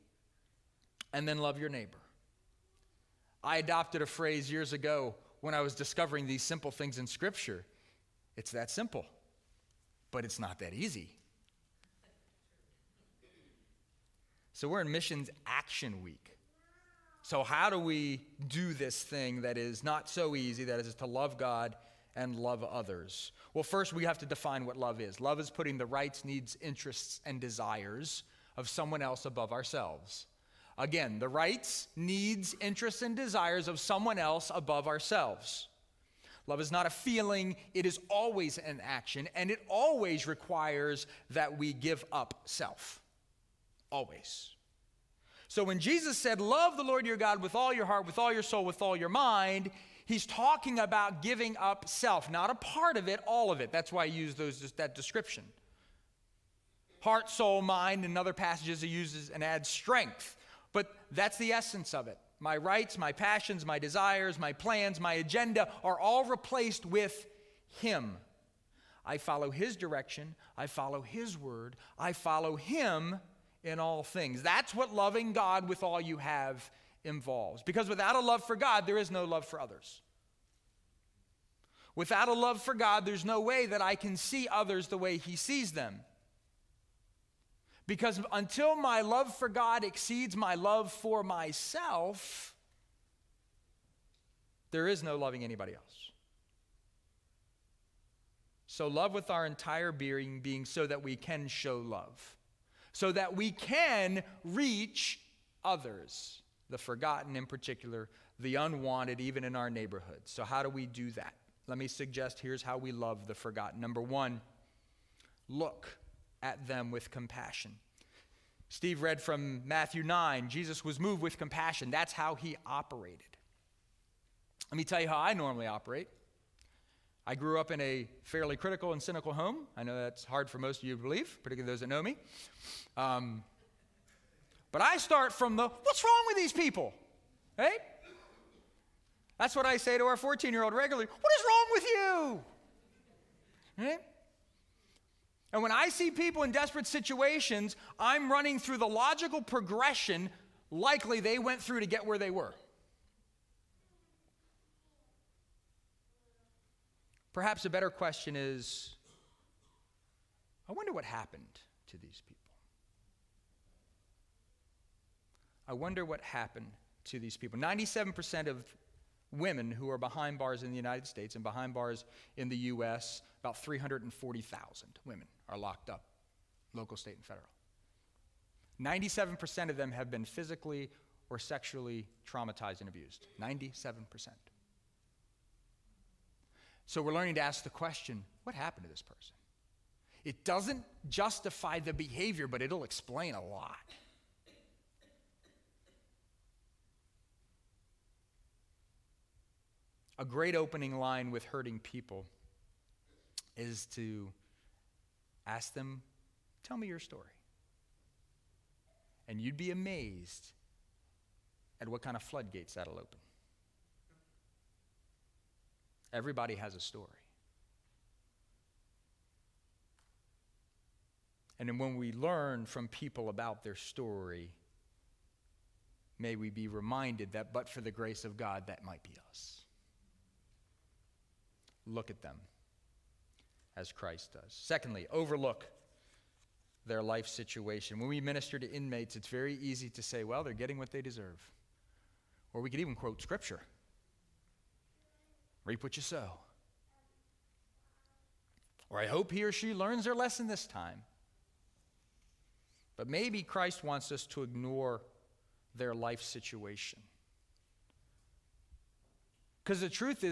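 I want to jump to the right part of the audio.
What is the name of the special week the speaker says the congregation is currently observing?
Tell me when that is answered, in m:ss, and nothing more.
0:14.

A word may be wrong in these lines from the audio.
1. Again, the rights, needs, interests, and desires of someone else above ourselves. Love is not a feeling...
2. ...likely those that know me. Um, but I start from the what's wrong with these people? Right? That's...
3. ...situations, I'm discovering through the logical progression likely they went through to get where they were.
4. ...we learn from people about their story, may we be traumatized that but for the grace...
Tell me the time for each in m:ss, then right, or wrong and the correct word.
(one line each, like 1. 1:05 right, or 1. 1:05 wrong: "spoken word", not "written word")
1. 0:30 right
2. 2:11 wrong: "particularly", not "likely"
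3. 2:26 wrong: "running", not "discovering"
4. 3:41 wrong: "reminded", not "traumatized".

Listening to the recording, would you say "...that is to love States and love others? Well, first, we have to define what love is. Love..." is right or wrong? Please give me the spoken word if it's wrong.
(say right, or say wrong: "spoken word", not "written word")
wrong: "God", not "States".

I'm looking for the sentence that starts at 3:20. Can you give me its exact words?
A great opening line with hurting people is to ask them, Tell me your story.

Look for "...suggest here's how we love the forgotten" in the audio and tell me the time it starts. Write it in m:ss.
1:51.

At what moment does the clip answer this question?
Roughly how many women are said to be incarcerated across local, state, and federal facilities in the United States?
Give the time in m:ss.
2:53.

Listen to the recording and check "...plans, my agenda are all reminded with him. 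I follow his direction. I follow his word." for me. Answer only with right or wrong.
wrong.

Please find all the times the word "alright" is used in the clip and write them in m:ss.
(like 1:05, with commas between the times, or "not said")
not said.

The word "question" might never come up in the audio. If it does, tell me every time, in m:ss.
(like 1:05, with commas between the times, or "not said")
2:37, 3:07.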